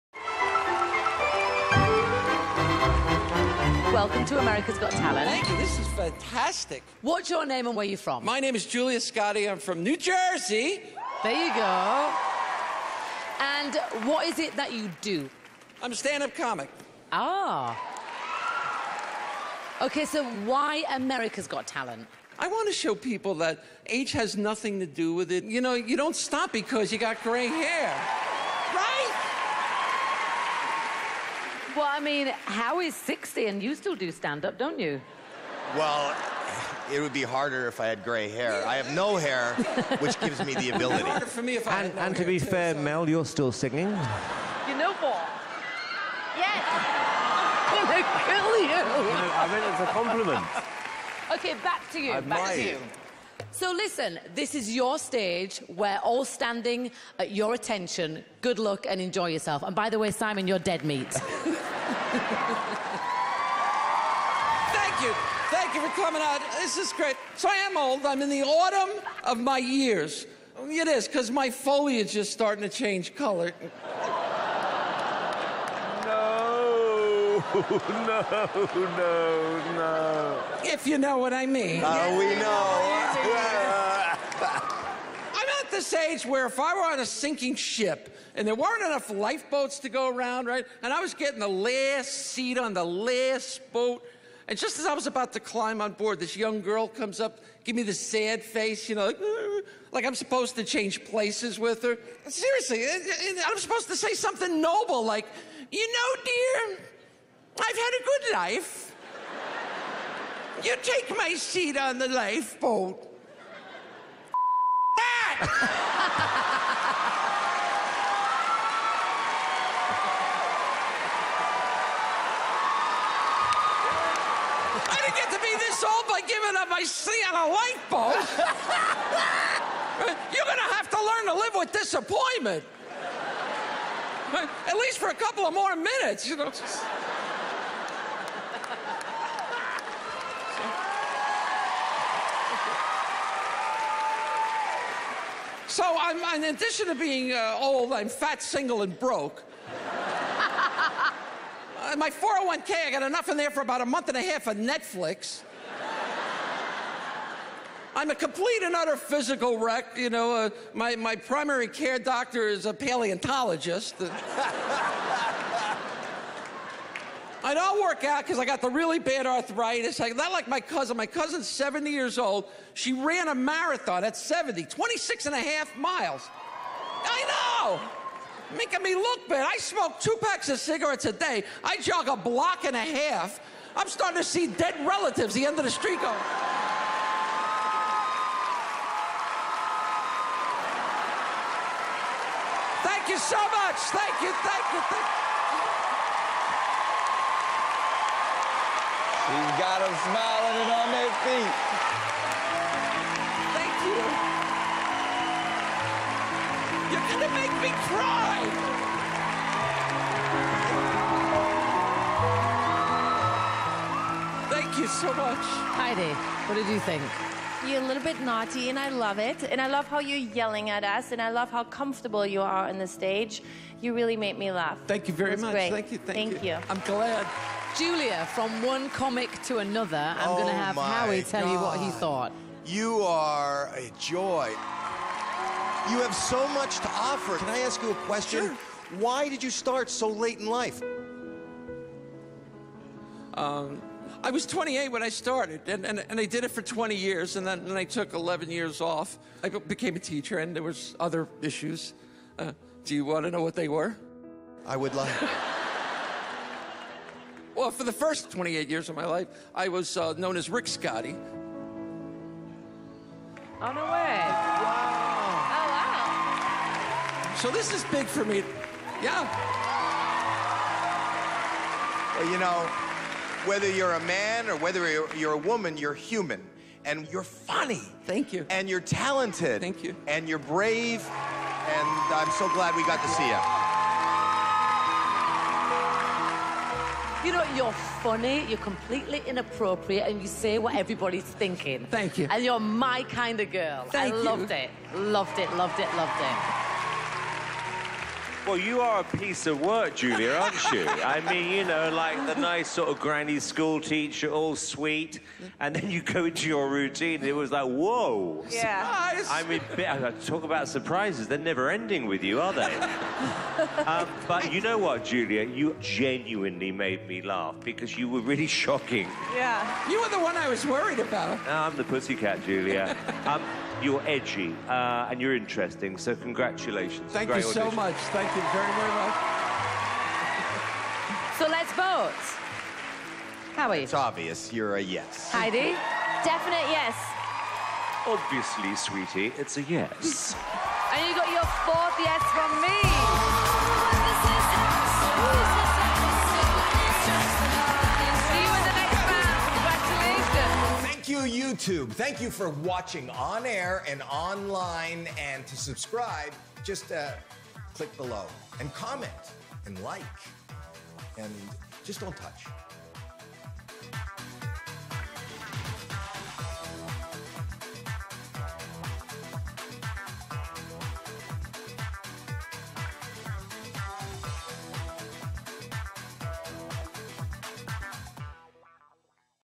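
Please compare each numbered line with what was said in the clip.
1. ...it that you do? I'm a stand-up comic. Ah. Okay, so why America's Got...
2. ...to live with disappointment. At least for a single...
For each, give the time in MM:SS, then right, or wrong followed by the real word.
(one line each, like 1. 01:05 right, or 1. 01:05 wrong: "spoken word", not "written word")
1. 00:14 right
2. 02:11 wrong: "couple", not "single".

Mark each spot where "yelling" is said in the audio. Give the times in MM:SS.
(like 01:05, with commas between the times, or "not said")
03:40.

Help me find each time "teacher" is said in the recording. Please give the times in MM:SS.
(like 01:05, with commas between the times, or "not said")
04:09, 05:03.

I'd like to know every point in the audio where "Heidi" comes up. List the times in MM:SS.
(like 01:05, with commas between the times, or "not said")
03:35, 05:35.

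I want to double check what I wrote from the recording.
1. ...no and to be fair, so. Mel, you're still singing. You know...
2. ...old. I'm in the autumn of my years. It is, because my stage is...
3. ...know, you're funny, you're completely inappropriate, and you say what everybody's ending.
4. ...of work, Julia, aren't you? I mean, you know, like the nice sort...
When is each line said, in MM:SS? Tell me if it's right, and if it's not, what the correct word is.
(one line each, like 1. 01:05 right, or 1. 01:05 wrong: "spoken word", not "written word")
1. 00:41 right
2. 01:07 wrong: "foliage", not "stage"
3. 04:47 wrong: "thinking", not "ending"
4. 04:59 right.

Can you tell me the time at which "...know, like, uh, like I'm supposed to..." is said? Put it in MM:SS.
01:38.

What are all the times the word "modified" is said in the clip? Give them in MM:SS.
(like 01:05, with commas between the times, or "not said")
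not said.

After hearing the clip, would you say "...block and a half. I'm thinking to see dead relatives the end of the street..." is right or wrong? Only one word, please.
wrong.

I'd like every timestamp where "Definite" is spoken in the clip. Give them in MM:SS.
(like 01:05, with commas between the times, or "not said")
05:36.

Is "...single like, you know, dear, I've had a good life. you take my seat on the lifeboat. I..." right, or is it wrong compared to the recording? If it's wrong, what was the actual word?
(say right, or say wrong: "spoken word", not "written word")
wrong: "noble", not "single".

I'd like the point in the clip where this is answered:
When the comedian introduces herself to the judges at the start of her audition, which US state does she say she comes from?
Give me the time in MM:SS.
00:09.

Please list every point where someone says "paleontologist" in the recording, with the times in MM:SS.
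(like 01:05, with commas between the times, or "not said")
02:42.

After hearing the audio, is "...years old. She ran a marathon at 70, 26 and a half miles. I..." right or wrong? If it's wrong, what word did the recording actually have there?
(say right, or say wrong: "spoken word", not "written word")
right.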